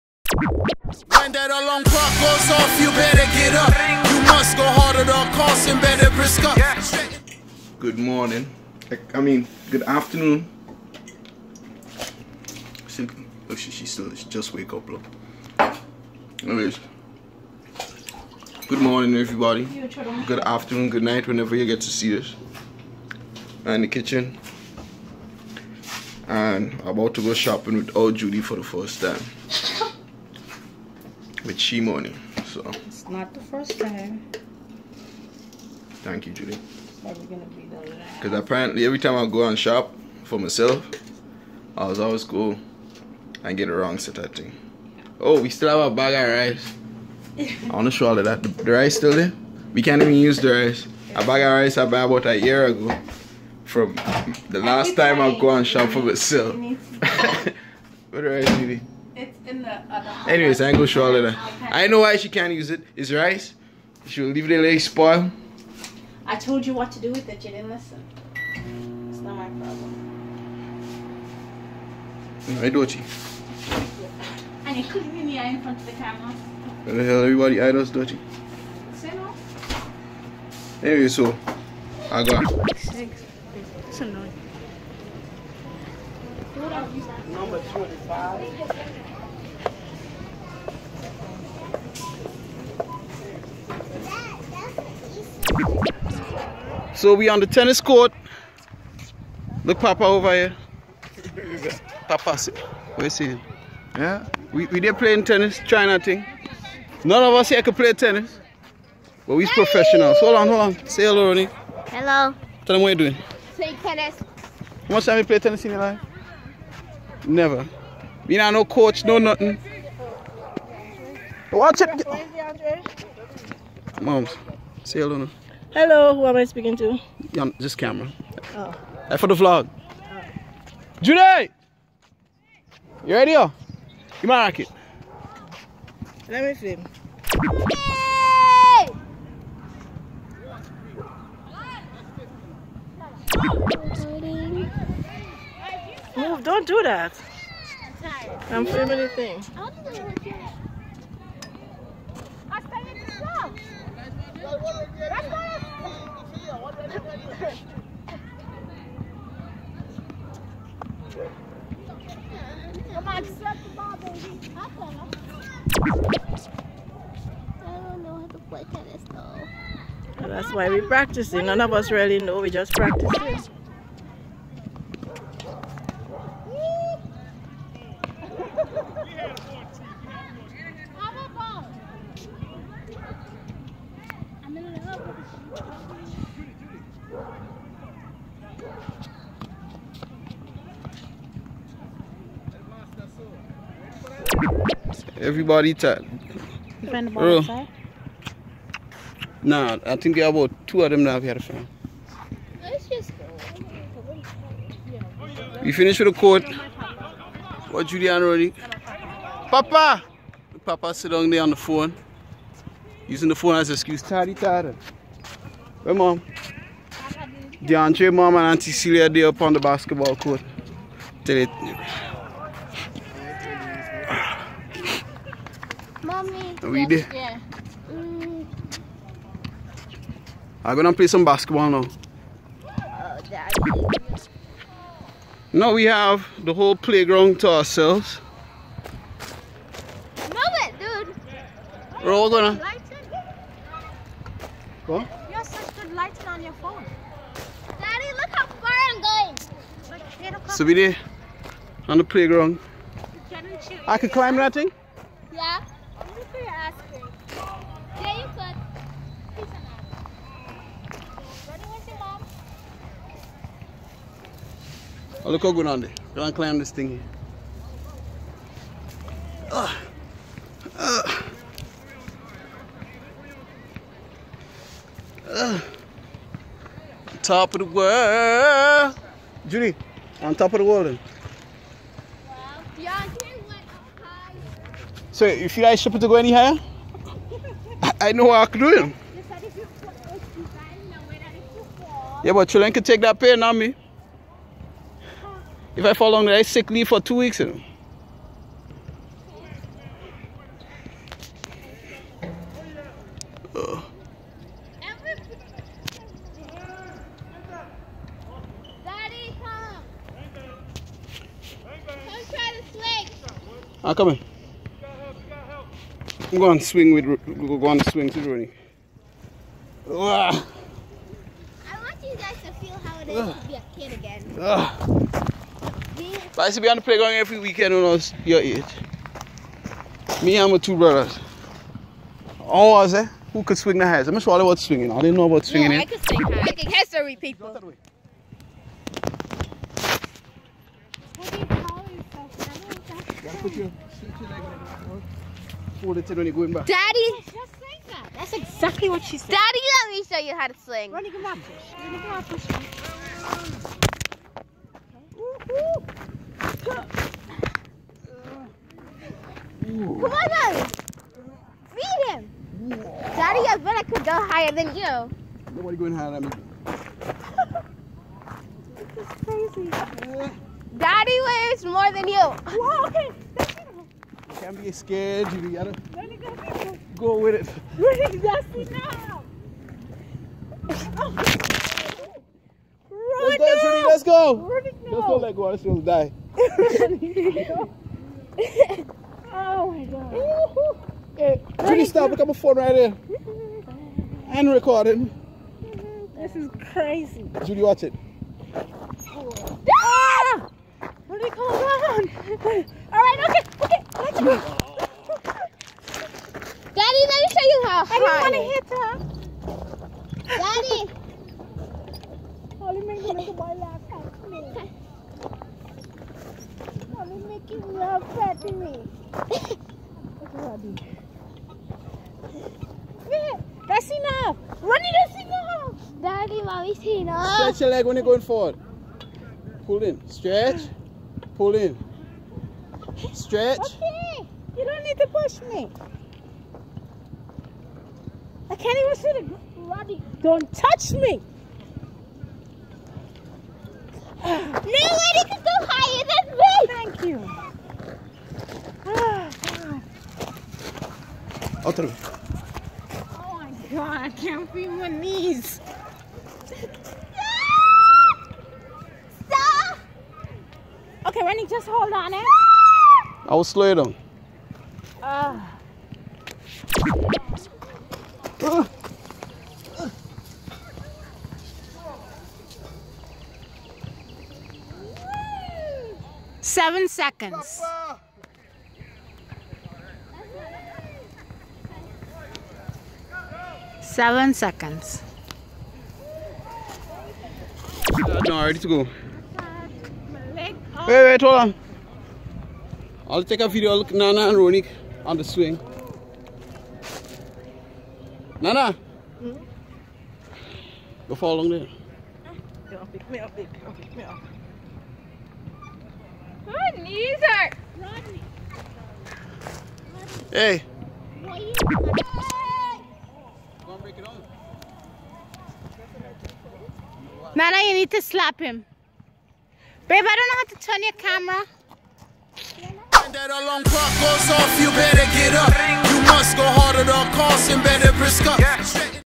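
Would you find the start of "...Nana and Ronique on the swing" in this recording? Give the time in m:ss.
8:13.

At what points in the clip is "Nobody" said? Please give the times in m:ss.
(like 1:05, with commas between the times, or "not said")
6:05, 7:24.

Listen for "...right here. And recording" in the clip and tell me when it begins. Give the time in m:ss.
6:32.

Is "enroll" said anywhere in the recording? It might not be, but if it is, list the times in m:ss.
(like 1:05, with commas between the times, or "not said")
not said.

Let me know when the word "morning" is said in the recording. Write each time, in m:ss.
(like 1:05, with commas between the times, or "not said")
0:07, 0:18.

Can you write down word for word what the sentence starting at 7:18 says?
I can't even see the bloody.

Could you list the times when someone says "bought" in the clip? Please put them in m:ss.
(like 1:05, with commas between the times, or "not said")
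0:51.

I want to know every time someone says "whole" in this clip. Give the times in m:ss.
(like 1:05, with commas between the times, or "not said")
3:56.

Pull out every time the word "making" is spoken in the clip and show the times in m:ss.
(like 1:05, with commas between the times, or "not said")
5:36, 6:52, 6:57.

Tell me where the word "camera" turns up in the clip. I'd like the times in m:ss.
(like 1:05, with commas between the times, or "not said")
1:15, 2:07, 8:40.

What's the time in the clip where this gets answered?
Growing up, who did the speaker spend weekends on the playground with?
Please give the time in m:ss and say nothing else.
5:30.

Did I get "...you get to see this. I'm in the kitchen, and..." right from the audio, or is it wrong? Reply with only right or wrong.
right.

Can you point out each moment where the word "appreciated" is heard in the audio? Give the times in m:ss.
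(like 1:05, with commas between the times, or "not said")
not said.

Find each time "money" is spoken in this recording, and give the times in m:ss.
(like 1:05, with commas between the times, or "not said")
0:31.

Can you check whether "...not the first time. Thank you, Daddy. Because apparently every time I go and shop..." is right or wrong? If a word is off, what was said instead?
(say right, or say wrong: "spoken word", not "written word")
wrong: "Julie", not "Daddy".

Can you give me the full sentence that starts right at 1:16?
Where the hell everybody idols dirty?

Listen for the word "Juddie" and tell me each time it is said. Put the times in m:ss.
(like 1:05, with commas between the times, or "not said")
0:28, 2:11, 4:39, 6:37.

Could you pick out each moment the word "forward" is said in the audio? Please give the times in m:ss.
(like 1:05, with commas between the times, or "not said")
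7:08.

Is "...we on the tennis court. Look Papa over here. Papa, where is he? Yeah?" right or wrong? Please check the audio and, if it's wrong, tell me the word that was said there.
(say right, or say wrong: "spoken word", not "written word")
right.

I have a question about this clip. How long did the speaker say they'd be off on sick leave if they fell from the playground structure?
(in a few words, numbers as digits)
two weeks.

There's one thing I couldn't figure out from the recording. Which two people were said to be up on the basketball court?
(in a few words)
Deondre's mom and Auntie Celia.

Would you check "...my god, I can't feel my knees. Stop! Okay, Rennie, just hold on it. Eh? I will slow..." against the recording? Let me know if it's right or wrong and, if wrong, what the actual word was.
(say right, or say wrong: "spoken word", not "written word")
right.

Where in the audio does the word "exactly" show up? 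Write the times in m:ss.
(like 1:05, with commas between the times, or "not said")
5:48, 6:18.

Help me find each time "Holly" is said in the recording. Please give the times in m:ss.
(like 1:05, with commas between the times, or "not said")
6:52, 6:56.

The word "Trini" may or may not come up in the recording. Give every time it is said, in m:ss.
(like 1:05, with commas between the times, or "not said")
6:23, 6:31.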